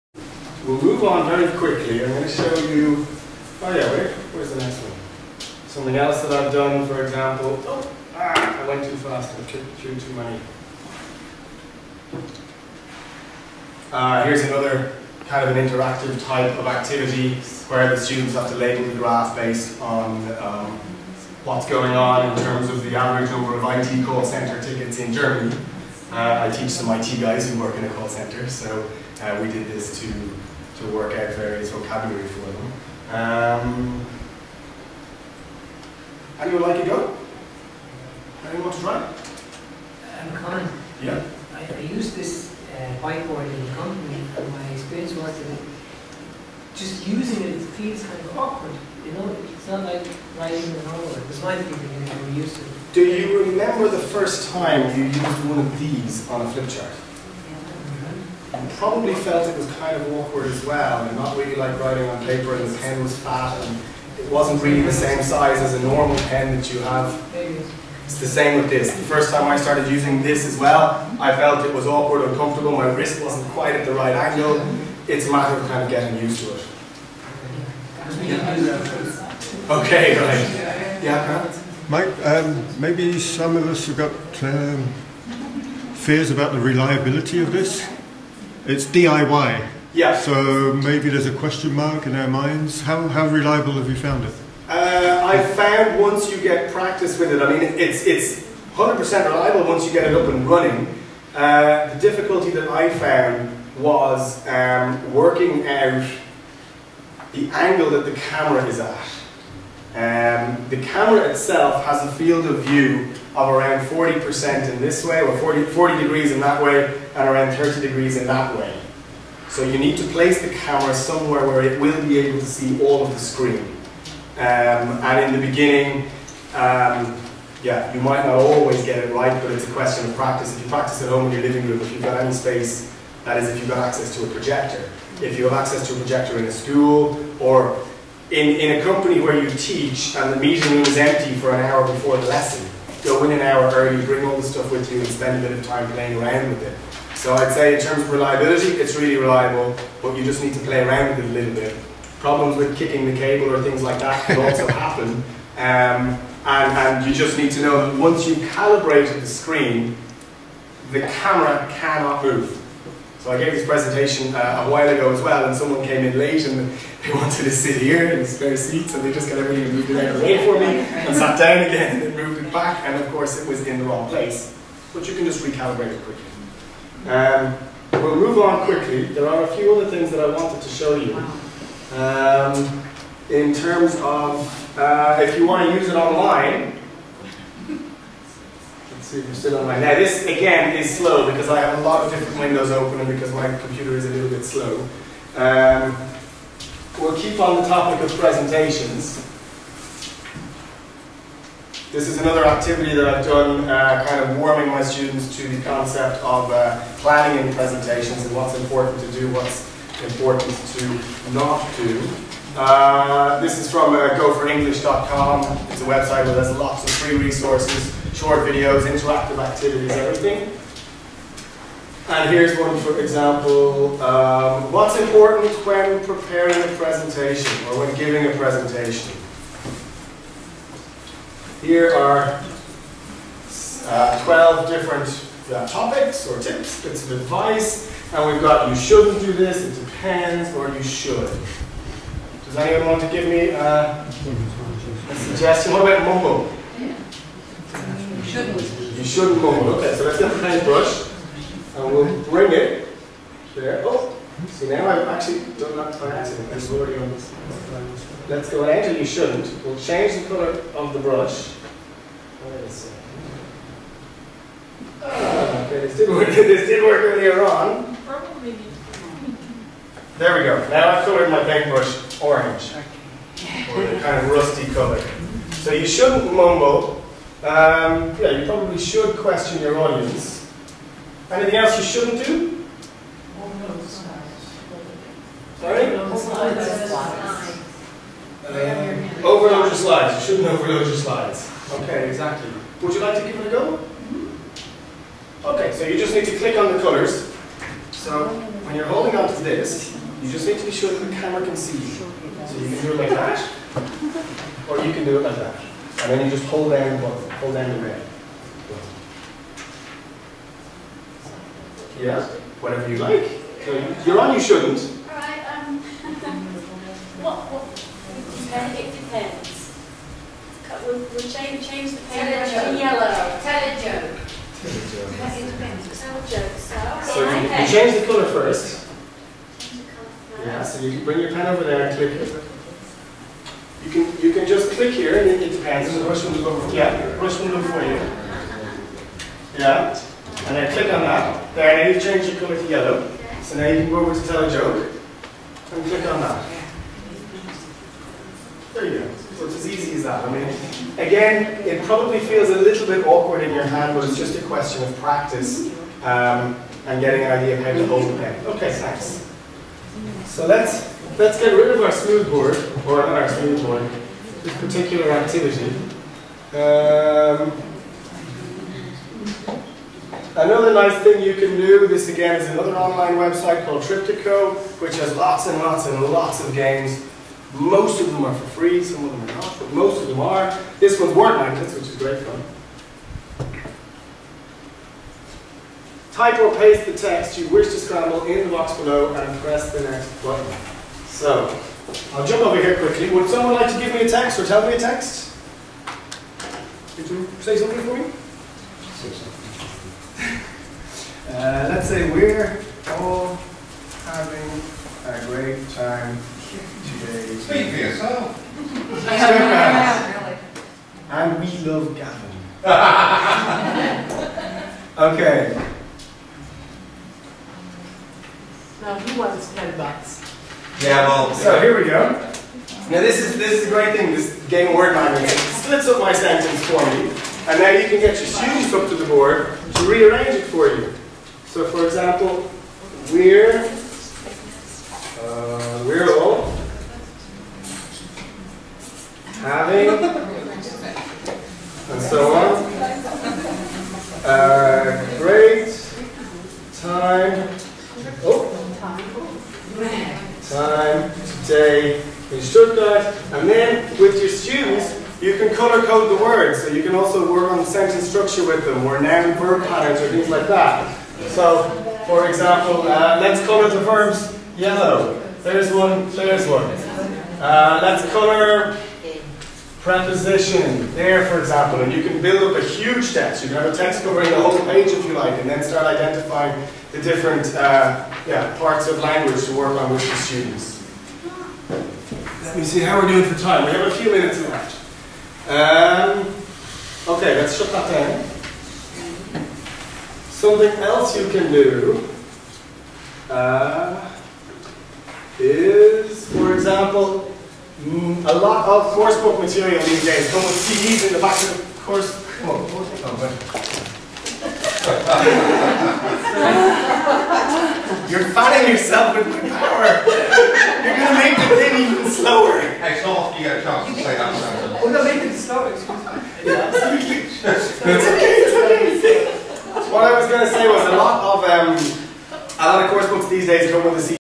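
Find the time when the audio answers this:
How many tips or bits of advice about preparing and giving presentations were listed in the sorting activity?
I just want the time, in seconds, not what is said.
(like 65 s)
234 s.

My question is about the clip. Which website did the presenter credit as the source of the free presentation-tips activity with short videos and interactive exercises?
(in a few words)
goforenglish.com.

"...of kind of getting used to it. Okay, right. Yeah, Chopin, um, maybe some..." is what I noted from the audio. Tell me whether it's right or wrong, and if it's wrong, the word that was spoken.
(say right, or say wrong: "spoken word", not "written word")
wrong: "Mike", not "Chopin".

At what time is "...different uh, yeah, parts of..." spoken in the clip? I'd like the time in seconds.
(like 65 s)
477 s.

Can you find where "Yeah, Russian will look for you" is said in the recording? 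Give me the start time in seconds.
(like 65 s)
336 s.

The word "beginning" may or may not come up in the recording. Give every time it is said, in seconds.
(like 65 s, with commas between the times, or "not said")
125 s.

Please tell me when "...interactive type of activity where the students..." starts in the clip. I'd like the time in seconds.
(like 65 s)
15 s.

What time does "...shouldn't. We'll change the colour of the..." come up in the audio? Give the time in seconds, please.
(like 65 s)
259 s.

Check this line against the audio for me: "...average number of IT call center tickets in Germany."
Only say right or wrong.
right.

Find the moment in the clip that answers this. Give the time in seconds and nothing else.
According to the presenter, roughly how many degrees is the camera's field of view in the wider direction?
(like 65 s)
115 s.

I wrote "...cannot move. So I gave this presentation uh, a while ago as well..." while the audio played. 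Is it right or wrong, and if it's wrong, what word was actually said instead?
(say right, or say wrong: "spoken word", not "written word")
right.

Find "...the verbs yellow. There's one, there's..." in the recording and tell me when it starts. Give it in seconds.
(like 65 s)
463 s.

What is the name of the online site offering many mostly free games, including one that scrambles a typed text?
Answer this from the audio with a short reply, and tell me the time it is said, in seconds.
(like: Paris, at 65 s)
Triptico, at 373 s.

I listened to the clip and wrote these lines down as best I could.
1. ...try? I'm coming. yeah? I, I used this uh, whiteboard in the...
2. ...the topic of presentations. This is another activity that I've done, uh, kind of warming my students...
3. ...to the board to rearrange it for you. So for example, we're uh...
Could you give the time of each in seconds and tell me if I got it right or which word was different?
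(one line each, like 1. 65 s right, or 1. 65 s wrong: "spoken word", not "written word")
1. 38 s right
2. 197 s right
3. 428 s right.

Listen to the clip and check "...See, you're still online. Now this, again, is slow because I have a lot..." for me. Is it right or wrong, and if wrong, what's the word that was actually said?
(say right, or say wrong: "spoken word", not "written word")
right.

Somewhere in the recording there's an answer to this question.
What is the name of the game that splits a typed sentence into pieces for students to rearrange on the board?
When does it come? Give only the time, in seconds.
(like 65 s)
381 s.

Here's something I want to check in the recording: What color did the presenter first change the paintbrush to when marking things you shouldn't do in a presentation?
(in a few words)
orange.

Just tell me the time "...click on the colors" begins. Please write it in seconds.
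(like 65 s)
296 s.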